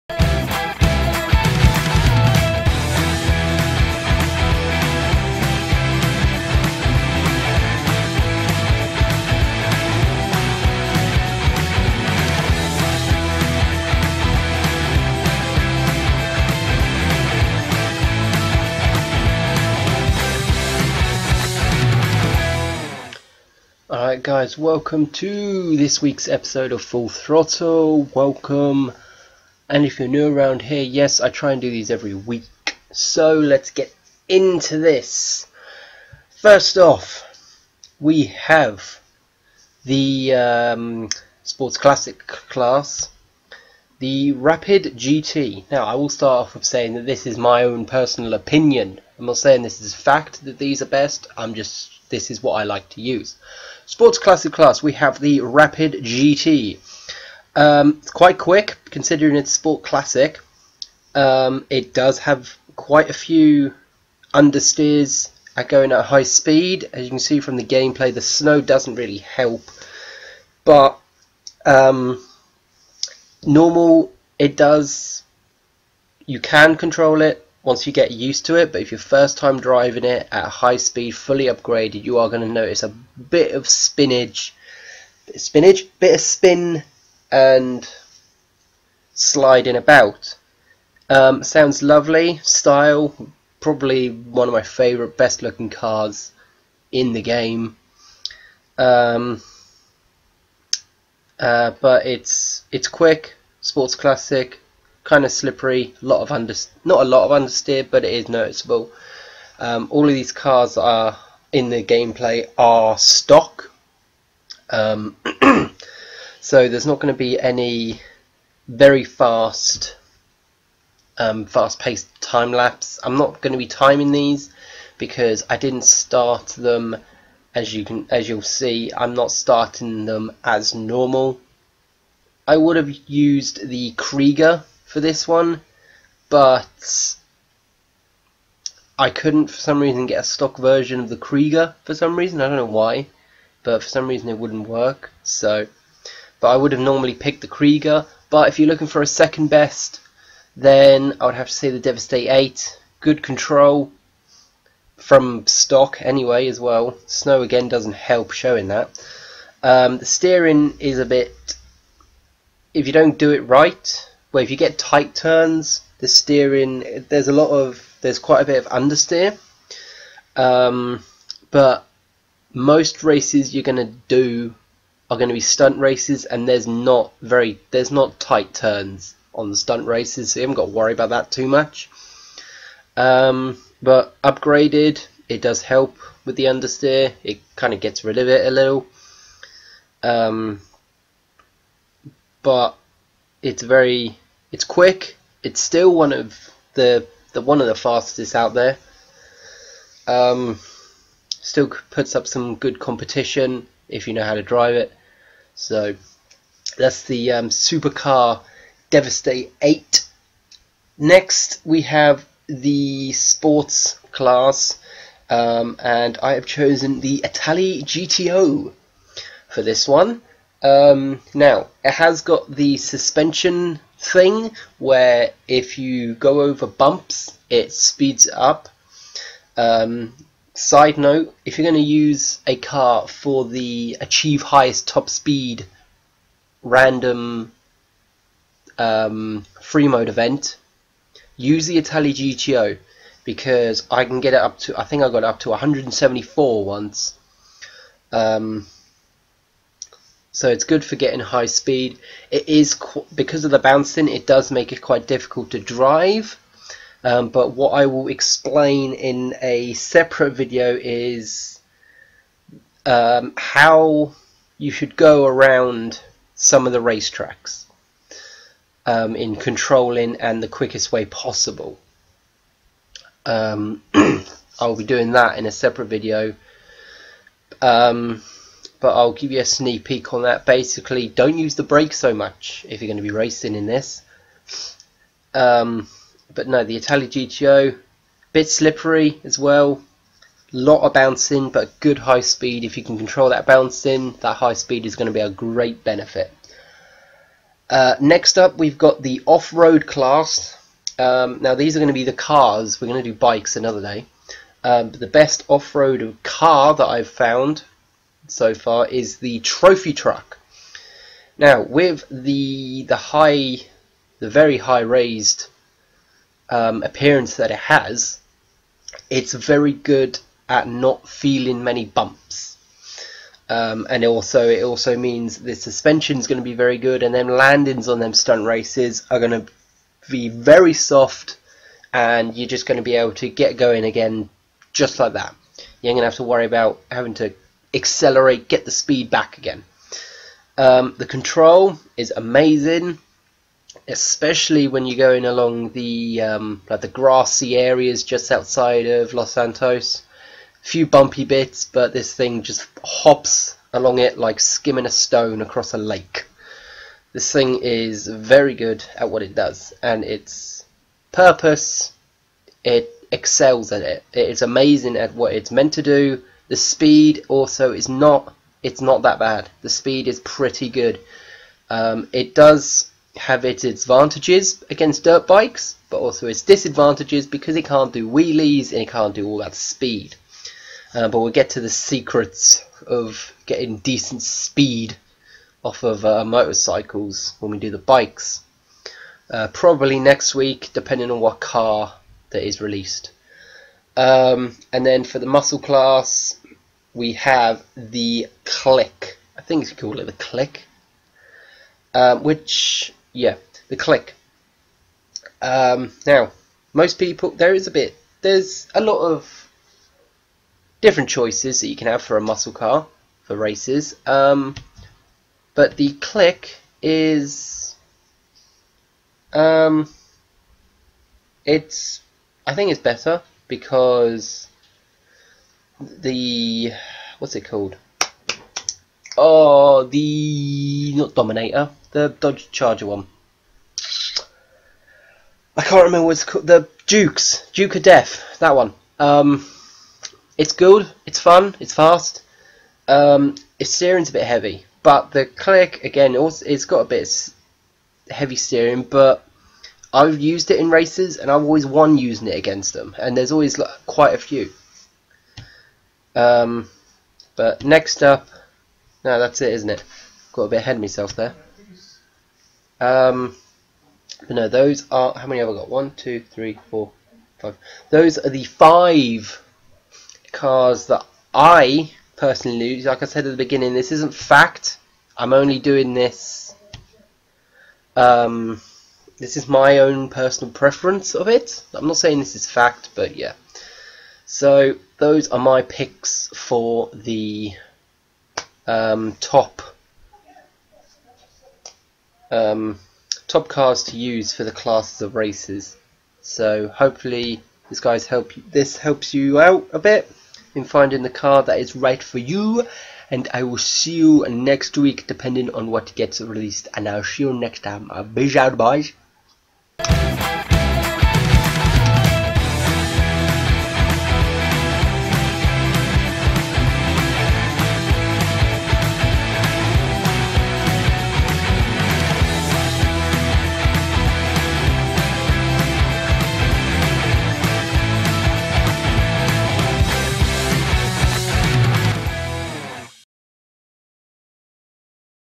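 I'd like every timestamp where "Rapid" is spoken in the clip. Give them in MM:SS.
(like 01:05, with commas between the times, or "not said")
00:44, 00:55.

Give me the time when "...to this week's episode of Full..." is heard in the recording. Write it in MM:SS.
00:25.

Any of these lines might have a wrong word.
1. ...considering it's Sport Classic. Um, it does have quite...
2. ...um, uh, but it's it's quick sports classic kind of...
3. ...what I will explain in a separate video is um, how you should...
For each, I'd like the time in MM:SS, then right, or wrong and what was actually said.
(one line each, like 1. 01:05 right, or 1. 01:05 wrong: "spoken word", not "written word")
1. 00:58 right
2. 01:38 right
3. 04:17 right.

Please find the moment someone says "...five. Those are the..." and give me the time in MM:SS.
07:47.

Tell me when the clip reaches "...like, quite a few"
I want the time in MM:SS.
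07:33.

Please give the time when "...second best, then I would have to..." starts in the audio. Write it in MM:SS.
02:29.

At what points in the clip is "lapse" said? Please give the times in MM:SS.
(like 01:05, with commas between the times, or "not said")
02:02.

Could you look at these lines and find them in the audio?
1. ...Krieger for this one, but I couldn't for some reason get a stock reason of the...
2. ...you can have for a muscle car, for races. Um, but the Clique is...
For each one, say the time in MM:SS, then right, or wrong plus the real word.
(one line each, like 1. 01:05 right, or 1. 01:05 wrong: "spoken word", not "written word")
1. 02:13 wrong: "version", not "reason"
2. 06:51 right.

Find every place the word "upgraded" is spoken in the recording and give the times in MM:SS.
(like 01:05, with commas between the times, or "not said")
01:21, 03:04.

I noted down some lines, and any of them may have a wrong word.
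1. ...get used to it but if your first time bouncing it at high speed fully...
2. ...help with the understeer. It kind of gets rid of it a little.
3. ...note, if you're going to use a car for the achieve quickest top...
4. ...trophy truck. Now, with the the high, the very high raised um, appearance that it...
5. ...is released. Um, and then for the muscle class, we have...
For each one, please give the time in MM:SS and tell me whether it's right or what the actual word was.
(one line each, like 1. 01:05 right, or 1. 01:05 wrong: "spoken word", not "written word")
1. 01:17 wrong: "driving", not "bouncing"
2. 03:05 right
3. 03:50 wrong: "highest", not "quickest"
4. 05:09 right
5. 06:32 right.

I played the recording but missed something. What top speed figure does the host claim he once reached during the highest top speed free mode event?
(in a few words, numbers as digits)
174.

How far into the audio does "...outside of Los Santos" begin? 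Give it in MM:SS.
05:48.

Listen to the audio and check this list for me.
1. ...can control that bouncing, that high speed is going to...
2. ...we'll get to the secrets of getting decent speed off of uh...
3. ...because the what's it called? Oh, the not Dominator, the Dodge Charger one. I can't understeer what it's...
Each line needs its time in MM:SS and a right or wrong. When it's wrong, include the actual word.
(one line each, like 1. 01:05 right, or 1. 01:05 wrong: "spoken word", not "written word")
1. 04:52 right
2. 06:21 right
3. 07:03 wrong: "remember", not "understeer".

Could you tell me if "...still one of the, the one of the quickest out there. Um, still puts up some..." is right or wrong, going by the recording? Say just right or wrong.
wrong.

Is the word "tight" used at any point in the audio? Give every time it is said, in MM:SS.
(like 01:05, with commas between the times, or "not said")
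02:44, 02:58.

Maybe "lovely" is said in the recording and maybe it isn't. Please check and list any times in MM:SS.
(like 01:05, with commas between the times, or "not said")
01:31.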